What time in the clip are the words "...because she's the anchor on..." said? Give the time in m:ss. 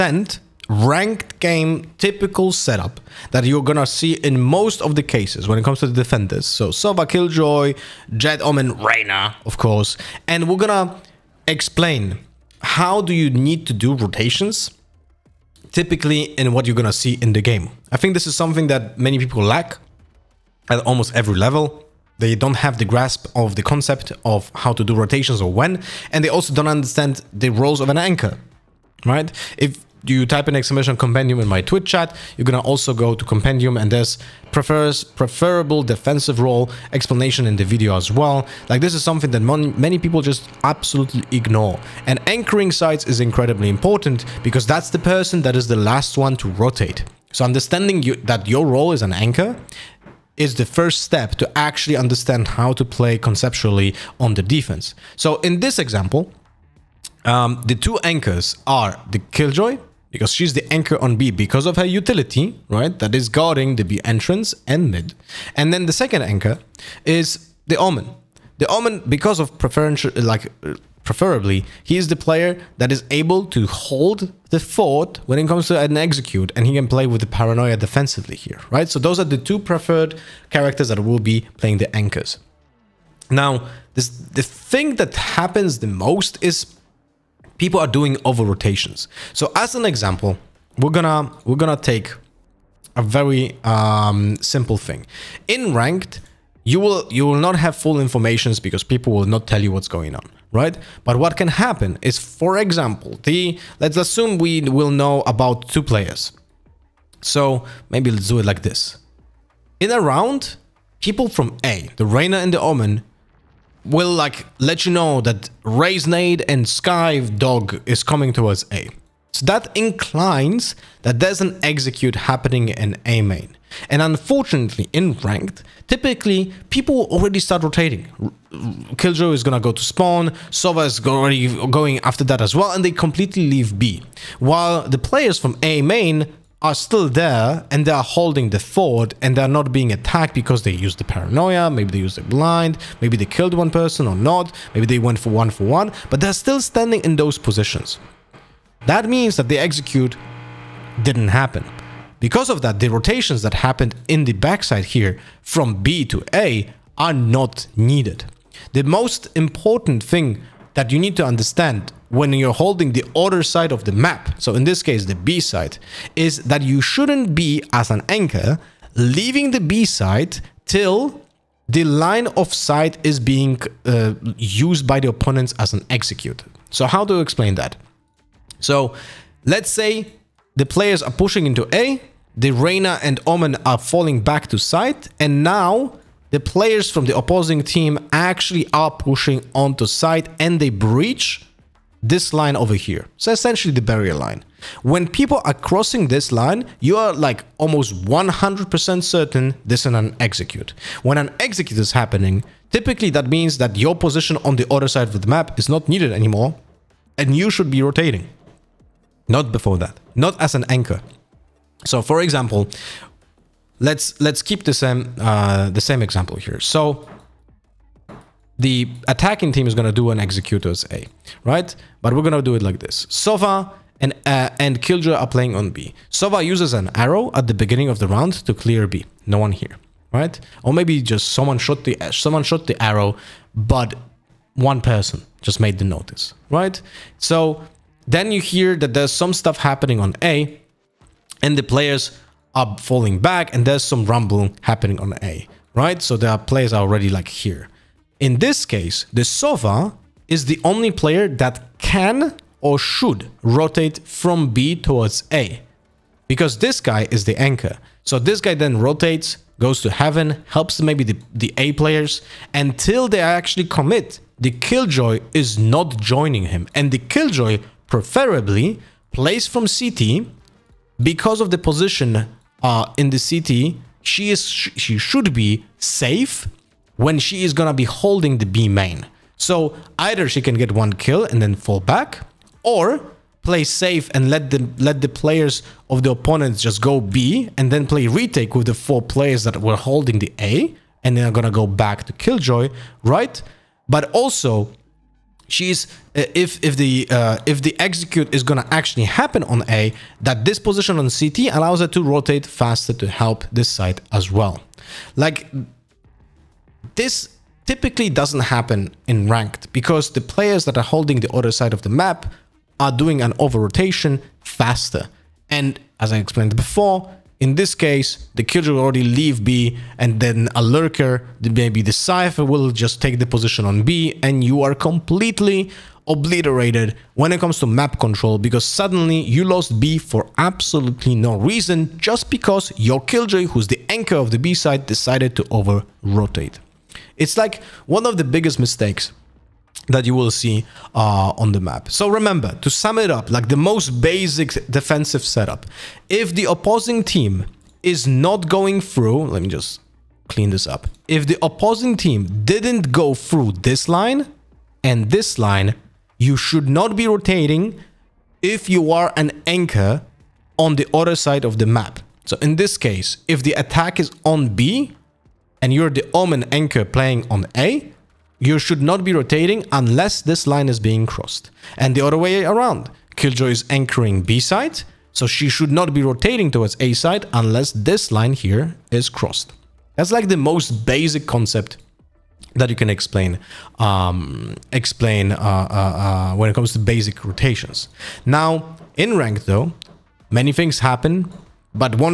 1:00.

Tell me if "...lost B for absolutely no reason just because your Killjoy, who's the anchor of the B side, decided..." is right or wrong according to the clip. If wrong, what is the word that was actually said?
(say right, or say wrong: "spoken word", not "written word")
right.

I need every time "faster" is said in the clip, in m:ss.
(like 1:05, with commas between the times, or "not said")
5:02, 5:14.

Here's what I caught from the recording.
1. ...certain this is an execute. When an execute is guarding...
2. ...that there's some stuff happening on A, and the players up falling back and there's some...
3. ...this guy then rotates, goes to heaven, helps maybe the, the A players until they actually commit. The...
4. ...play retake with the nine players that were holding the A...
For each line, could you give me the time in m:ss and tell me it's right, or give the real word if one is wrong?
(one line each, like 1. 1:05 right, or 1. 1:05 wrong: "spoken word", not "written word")
1. 3:19 wrong: "happening", not "guarding"
2. 3:58 right
3. 4:18 right
4. 4:47 wrong: "four", not "nine".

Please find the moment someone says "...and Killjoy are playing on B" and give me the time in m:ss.
3:44.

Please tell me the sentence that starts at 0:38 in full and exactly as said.
Like this is something that many people just absolutely ignore.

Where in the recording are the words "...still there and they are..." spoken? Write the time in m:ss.
2:16.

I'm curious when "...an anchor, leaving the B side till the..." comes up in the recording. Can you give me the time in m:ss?
2:47.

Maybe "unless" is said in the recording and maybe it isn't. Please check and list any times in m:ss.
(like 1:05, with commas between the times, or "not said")
6:09, 6:17.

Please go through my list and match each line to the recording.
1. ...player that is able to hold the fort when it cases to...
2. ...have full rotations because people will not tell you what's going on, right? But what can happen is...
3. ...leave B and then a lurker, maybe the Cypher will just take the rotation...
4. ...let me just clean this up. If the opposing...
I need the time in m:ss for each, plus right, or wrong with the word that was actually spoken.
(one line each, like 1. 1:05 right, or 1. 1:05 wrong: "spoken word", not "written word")
1. 1:12 wrong: "comes", not "cases"
2. 1:37 wrong: "informations", not "rotations"
3. 5:19 wrong: "position", not "rotation"
4. 5:49 right.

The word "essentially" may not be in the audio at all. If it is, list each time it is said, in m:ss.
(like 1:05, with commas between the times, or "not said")
3:13.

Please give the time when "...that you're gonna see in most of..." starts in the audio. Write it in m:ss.
0:03.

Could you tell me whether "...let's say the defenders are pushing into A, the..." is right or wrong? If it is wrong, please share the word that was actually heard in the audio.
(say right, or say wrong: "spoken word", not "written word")
wrong: "players", not "defenders".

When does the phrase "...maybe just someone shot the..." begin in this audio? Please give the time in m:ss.
3:50.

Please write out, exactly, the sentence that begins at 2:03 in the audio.
And unfortunately, in ranked, typically people already start rotating.